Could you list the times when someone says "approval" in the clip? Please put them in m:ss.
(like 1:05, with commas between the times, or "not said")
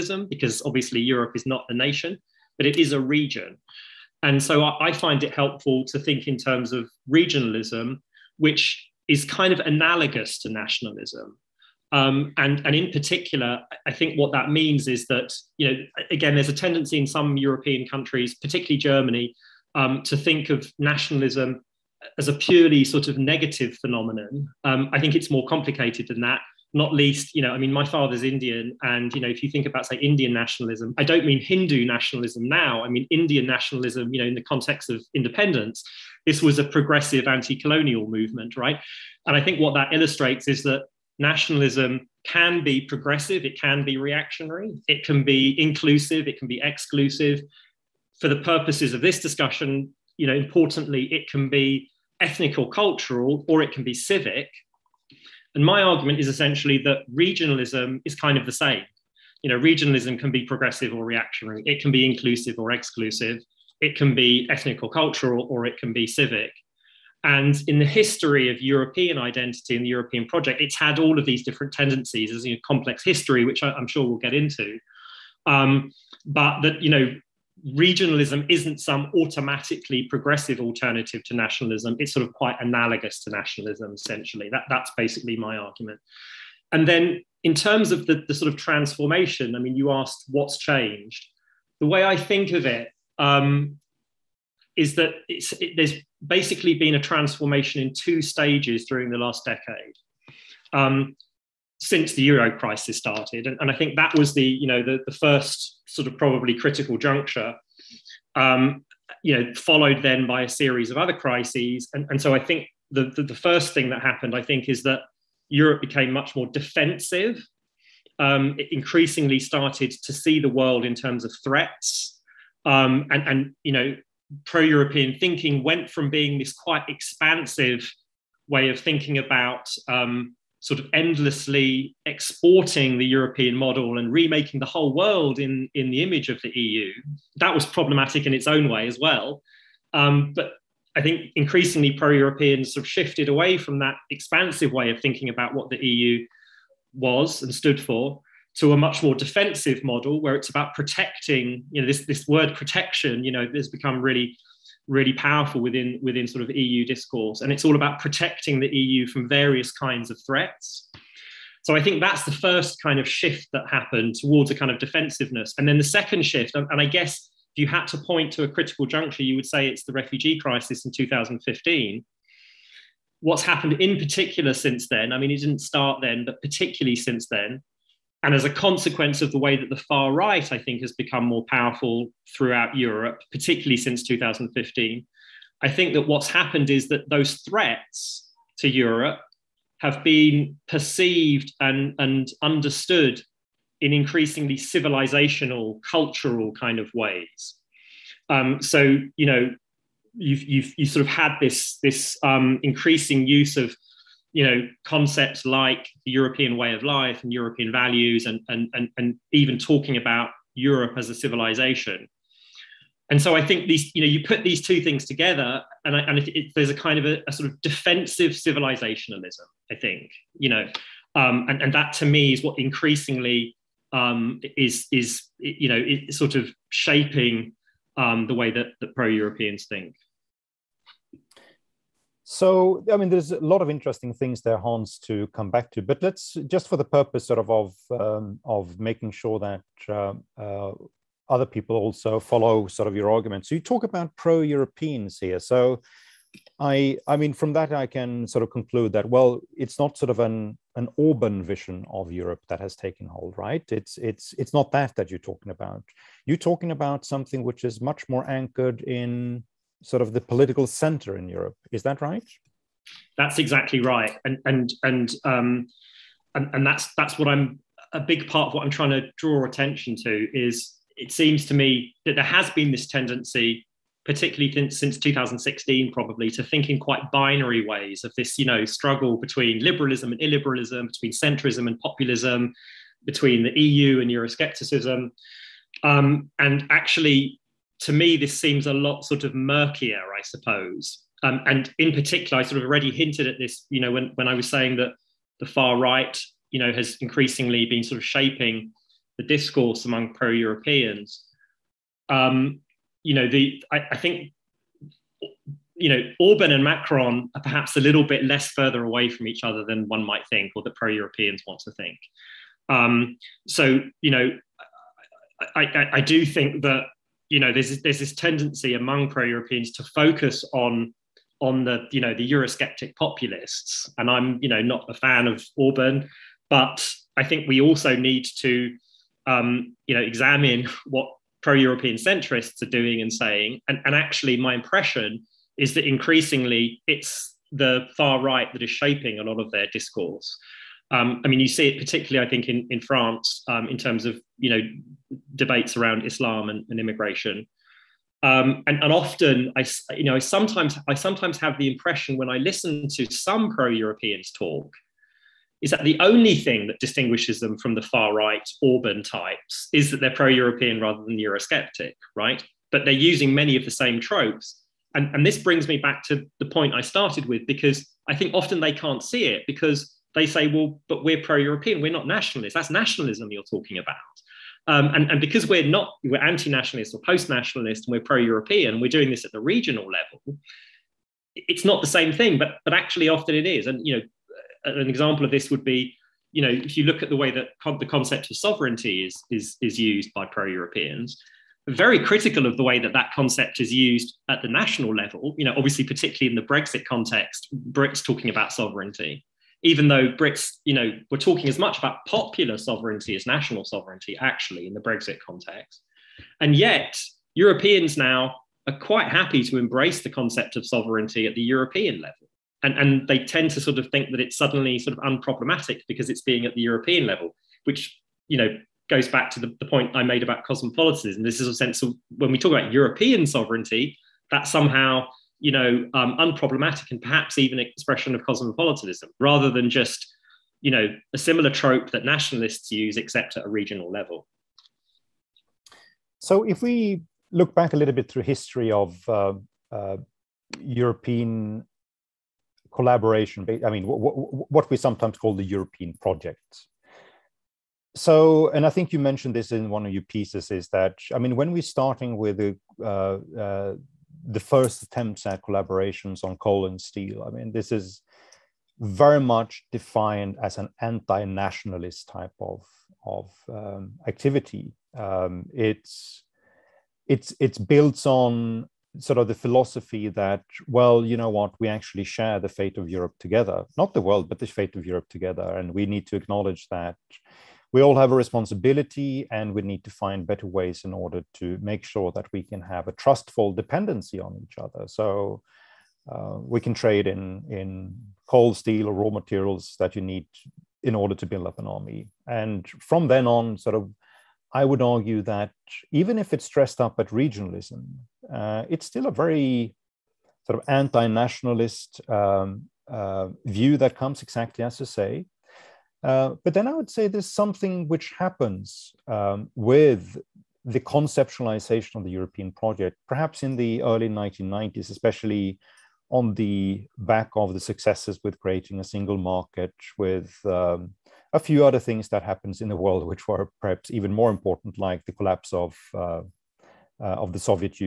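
not said.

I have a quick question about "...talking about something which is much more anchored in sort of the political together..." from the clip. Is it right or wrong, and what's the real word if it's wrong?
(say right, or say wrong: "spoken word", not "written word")
wrong: "center", not "together".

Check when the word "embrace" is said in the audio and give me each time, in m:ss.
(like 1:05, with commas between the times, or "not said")
6:49.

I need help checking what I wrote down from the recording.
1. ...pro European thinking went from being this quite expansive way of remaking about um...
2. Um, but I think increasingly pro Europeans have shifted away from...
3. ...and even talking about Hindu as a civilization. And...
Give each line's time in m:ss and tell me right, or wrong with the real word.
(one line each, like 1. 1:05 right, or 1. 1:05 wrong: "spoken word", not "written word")
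1. 2:04 wrong: "thinking", not "remaking"
2. 2:19 right
3. 3:28 wrong: "Europe", not "Hindu".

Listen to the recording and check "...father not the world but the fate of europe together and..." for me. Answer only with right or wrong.
wrong.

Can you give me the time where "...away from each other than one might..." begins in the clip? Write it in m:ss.
5:08.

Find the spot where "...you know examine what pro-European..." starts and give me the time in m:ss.
5:29.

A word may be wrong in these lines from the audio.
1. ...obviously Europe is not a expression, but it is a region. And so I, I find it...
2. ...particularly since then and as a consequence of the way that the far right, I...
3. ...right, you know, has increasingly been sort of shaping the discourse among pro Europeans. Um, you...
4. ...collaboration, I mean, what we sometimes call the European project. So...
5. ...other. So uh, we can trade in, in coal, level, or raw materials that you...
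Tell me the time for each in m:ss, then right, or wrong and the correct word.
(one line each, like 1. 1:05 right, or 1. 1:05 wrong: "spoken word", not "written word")
1. 0:00 wrong: "nation", not "expression"
2. 2:56 right
3. 4:55 right
4. 7:22 right
5. 8:04 wrong: "steel", not "level".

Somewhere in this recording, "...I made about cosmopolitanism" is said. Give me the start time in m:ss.
6:59.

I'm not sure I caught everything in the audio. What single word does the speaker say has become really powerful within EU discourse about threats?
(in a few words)
protection.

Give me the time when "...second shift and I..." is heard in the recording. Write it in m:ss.
2:45.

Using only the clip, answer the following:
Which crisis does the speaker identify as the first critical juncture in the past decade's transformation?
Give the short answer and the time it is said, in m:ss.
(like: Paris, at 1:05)
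euro crisis, at 1:42.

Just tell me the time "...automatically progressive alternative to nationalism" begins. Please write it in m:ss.
1:19.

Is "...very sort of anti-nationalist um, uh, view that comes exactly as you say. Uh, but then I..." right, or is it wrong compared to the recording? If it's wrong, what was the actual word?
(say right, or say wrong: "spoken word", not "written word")
right.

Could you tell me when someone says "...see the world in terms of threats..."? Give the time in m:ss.
2:00.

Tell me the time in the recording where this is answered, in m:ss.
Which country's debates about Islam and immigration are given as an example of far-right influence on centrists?
5:42.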